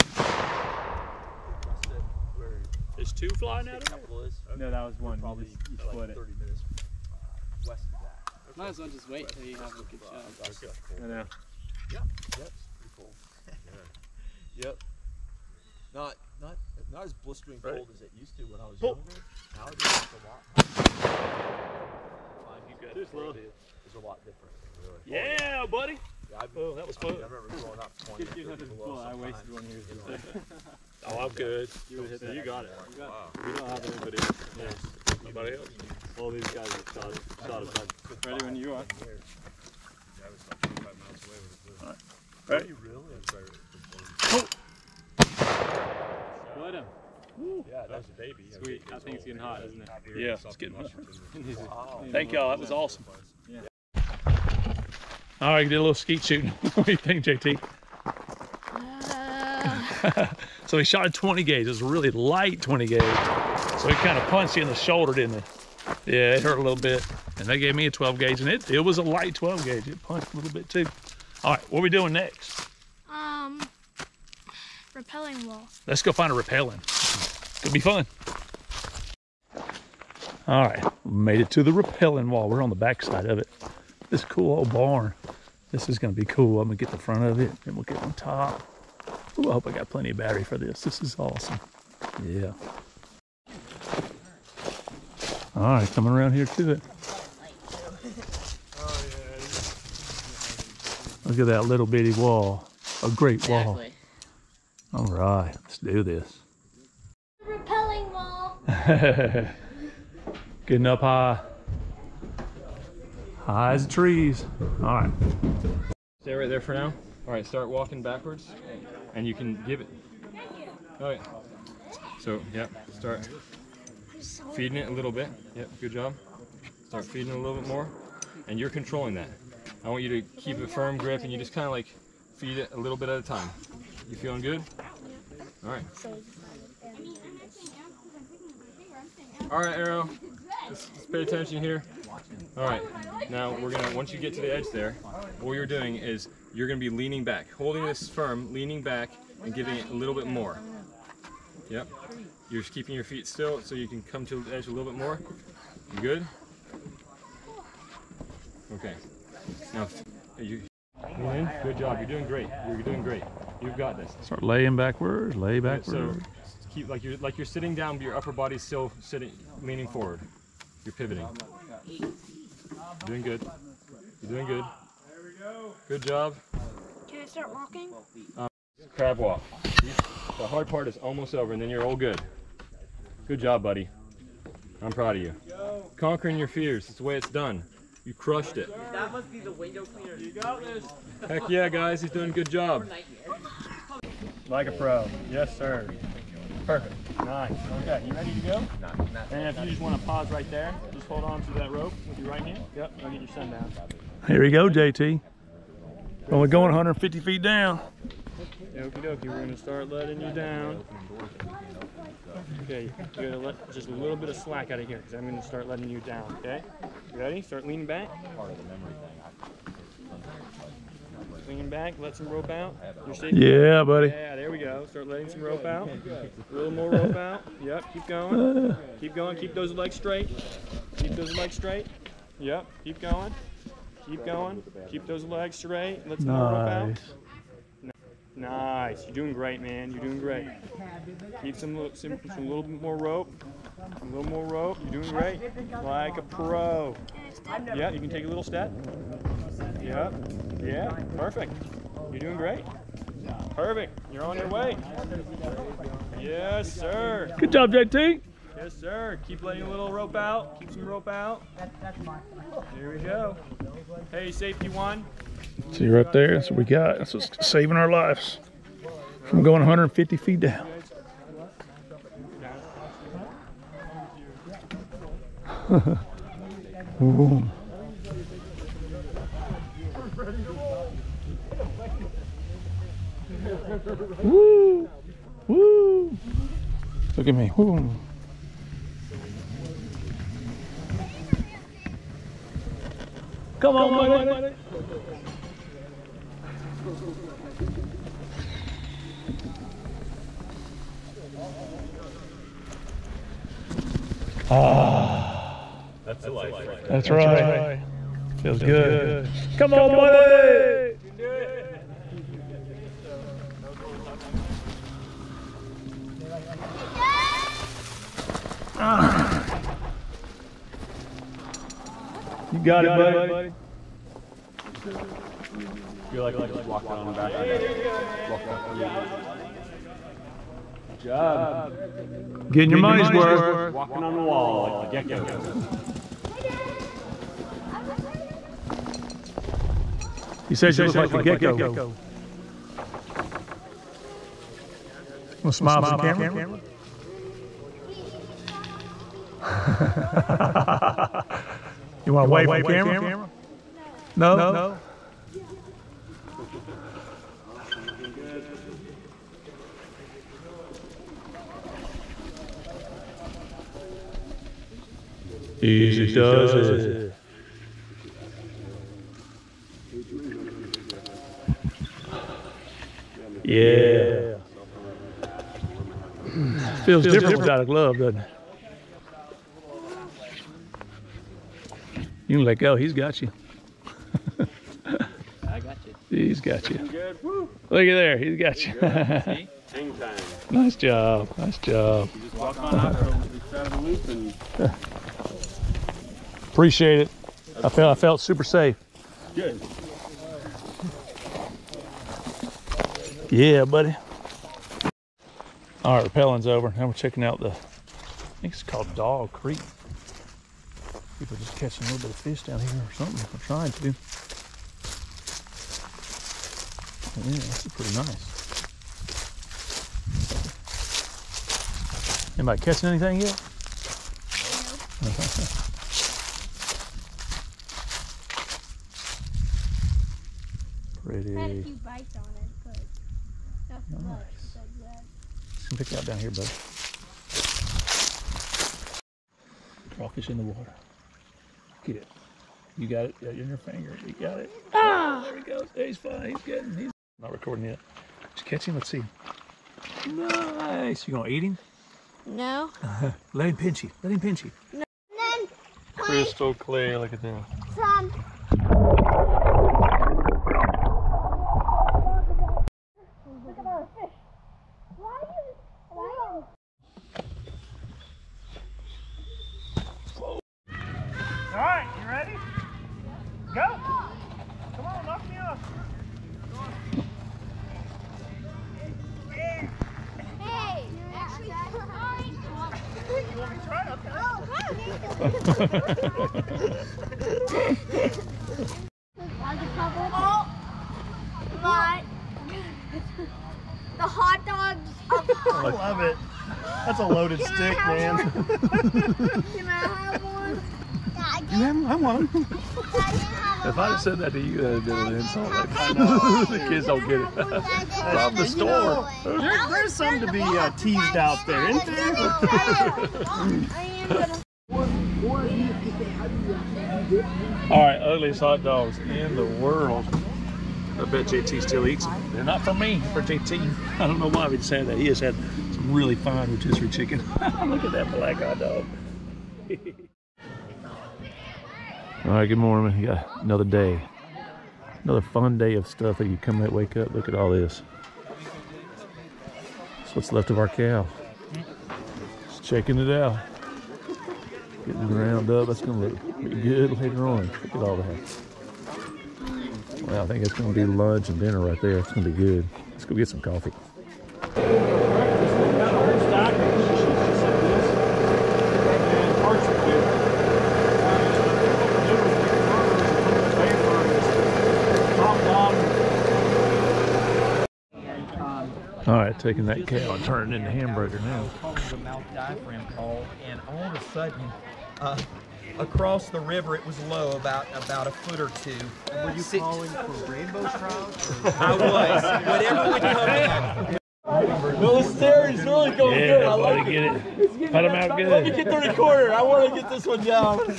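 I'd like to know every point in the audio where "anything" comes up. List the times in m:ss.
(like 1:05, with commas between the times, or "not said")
7:02.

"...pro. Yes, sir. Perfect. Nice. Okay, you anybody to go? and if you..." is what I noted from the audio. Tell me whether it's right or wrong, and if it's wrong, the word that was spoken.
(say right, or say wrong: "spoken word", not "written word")
wrong: "ready", not "anybody".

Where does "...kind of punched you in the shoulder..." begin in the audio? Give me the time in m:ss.
1:03.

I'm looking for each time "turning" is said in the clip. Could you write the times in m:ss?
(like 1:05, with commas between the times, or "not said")
9:30.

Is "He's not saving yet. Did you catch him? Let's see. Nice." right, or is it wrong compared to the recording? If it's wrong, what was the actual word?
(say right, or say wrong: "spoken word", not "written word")
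wrong: "recording", not "saving".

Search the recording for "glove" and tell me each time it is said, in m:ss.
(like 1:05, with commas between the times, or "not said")
6:17.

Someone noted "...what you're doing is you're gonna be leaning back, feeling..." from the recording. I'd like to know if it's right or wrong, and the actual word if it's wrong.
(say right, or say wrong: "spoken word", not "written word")
wrong: "holding", not "feeling".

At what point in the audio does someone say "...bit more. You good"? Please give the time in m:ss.
2:34.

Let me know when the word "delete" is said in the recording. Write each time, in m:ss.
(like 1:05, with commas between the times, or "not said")
not said.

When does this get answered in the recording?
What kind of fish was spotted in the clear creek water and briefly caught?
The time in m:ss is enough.
7:19.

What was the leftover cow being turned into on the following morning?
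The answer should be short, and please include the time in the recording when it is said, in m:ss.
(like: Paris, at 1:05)
Hamburger, at 9:30.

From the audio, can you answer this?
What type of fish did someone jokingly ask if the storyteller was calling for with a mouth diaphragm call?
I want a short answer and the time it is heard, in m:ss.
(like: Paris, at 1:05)
Rainbow trout, at 9:40.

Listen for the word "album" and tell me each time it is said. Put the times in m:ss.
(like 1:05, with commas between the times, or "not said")
not said.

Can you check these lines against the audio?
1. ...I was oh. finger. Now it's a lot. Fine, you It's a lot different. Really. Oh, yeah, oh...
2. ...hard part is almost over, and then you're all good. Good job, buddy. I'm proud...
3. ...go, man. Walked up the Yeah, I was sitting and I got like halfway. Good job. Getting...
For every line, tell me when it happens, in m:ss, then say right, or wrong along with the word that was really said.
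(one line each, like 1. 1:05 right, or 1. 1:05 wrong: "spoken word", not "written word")
1. 0:18 wrong: "younger", not "finger"
2. 3:00 right
3. 5:27 wrong: "running", not "sitting".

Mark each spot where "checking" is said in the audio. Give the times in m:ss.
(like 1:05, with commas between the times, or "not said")
6:46, 9:02.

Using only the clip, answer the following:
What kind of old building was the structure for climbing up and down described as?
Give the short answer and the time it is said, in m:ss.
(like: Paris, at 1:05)
Barn, at 1:24.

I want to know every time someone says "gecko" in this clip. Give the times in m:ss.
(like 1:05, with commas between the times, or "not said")
5:34, 5:41.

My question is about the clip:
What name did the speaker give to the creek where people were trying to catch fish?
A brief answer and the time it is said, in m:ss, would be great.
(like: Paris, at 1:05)
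Dog Creek, at 6:48.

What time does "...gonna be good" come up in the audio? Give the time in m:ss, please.
9:12.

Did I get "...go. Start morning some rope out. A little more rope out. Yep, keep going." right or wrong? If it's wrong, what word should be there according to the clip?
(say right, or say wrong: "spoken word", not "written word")
wrong: "letting", not "morning".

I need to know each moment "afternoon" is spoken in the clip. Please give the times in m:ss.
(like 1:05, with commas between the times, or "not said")
not said.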